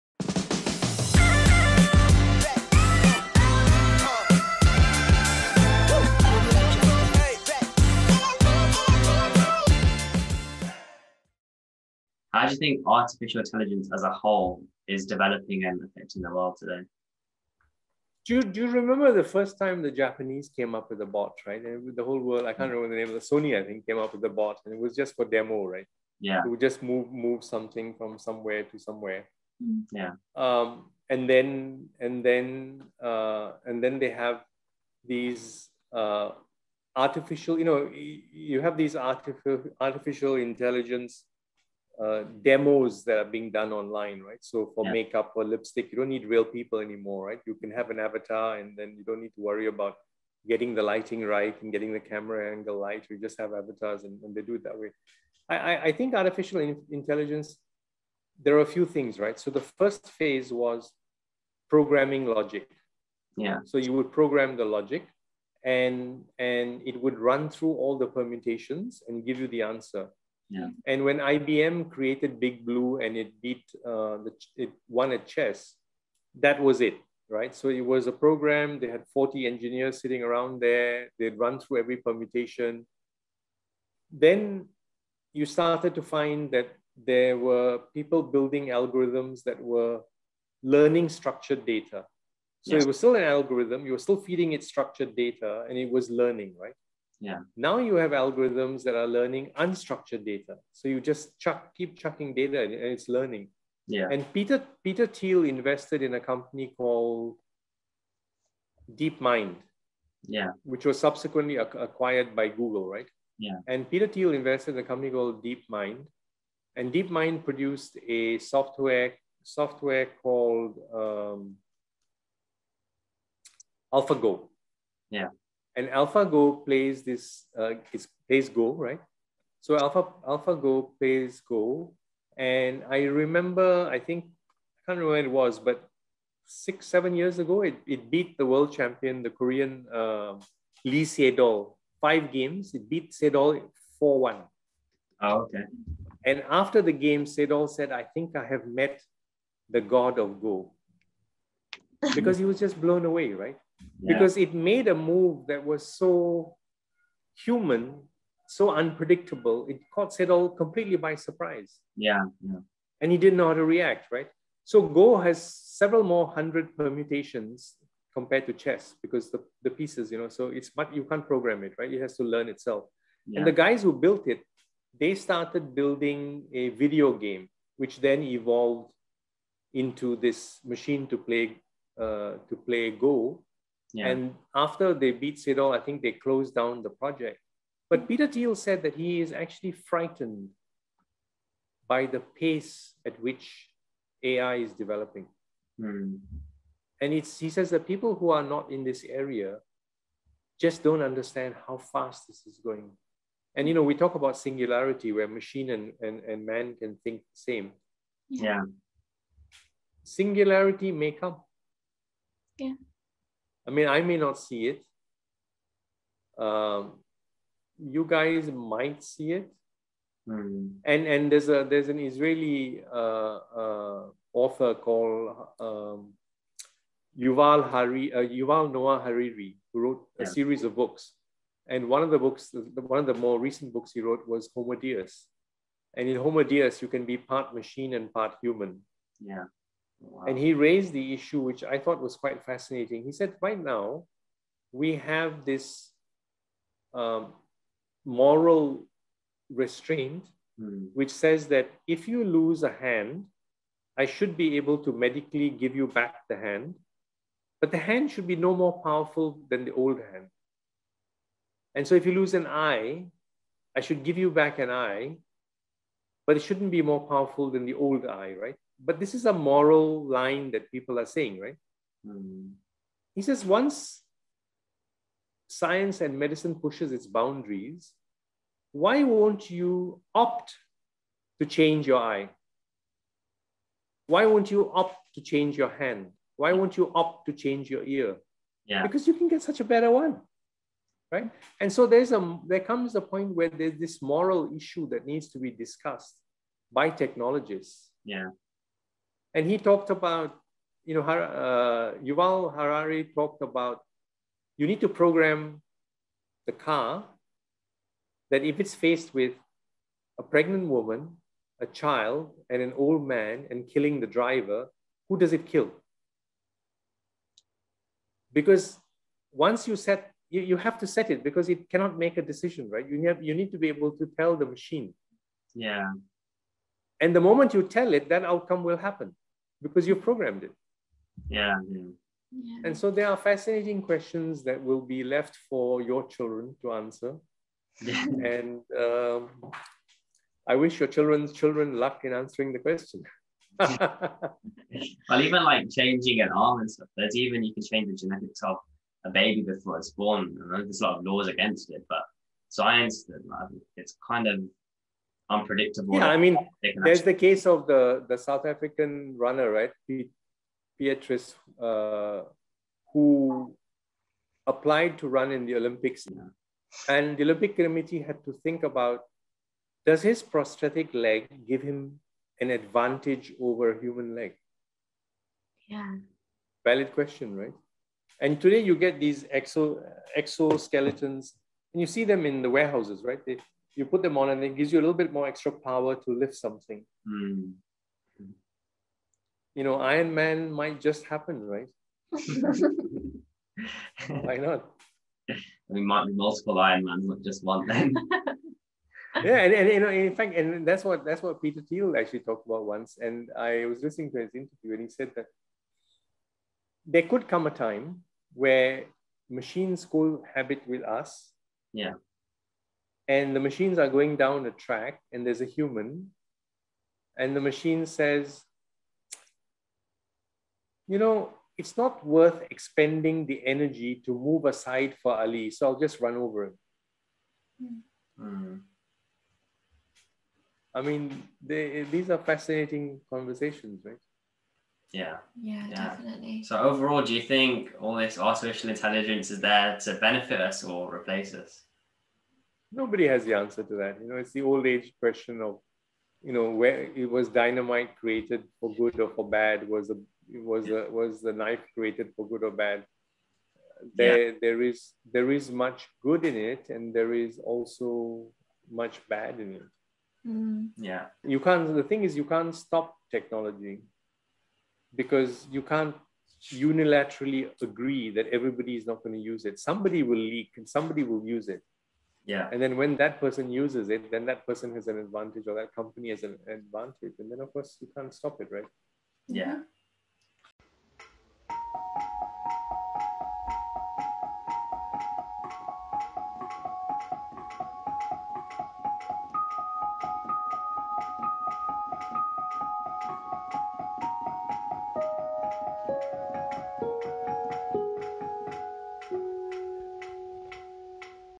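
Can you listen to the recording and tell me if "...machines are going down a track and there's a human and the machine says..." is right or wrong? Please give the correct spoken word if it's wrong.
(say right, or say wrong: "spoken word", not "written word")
right.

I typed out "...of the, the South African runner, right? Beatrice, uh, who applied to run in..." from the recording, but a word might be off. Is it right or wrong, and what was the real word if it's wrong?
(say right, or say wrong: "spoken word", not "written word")
right.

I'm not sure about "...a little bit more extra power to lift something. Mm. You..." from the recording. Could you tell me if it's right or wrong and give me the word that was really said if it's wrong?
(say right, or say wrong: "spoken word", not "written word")
right.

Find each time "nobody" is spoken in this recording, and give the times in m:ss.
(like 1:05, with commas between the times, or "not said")
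7:22.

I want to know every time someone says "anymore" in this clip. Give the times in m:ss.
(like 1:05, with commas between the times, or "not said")
0:46.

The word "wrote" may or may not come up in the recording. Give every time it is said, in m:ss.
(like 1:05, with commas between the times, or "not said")
3:49, 3:54.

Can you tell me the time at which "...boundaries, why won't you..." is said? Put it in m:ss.
4:37.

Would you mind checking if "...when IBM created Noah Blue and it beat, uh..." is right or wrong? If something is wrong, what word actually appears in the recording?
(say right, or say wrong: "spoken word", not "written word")
wrong: "Big", not "Noah".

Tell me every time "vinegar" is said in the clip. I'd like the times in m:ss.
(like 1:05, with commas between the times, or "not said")
not said.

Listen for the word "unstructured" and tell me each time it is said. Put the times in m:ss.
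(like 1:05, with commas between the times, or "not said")
1:39.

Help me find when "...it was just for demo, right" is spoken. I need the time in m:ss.
0:24.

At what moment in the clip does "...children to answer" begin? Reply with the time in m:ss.
5:36.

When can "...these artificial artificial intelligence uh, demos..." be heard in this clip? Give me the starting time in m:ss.
0:38.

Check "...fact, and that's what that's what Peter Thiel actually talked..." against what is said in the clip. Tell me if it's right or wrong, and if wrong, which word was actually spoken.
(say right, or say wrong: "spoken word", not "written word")
right.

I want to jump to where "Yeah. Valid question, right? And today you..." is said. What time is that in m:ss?
6:15.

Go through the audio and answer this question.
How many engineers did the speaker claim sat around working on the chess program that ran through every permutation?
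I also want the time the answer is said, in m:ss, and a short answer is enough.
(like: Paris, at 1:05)
40, at 1:19.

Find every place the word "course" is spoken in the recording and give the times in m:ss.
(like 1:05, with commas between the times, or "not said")
7:57.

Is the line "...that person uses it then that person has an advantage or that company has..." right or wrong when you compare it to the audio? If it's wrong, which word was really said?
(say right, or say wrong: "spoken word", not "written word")
right.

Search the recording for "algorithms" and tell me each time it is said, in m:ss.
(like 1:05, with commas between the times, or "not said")
1:28, 1:33, 1:38.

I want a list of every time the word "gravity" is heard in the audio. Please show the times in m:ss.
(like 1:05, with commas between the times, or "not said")
not said.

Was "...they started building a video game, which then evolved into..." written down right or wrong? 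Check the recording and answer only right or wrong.
right.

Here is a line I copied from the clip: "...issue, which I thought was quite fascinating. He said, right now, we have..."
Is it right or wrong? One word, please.
right.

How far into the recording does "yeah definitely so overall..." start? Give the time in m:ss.
7:15.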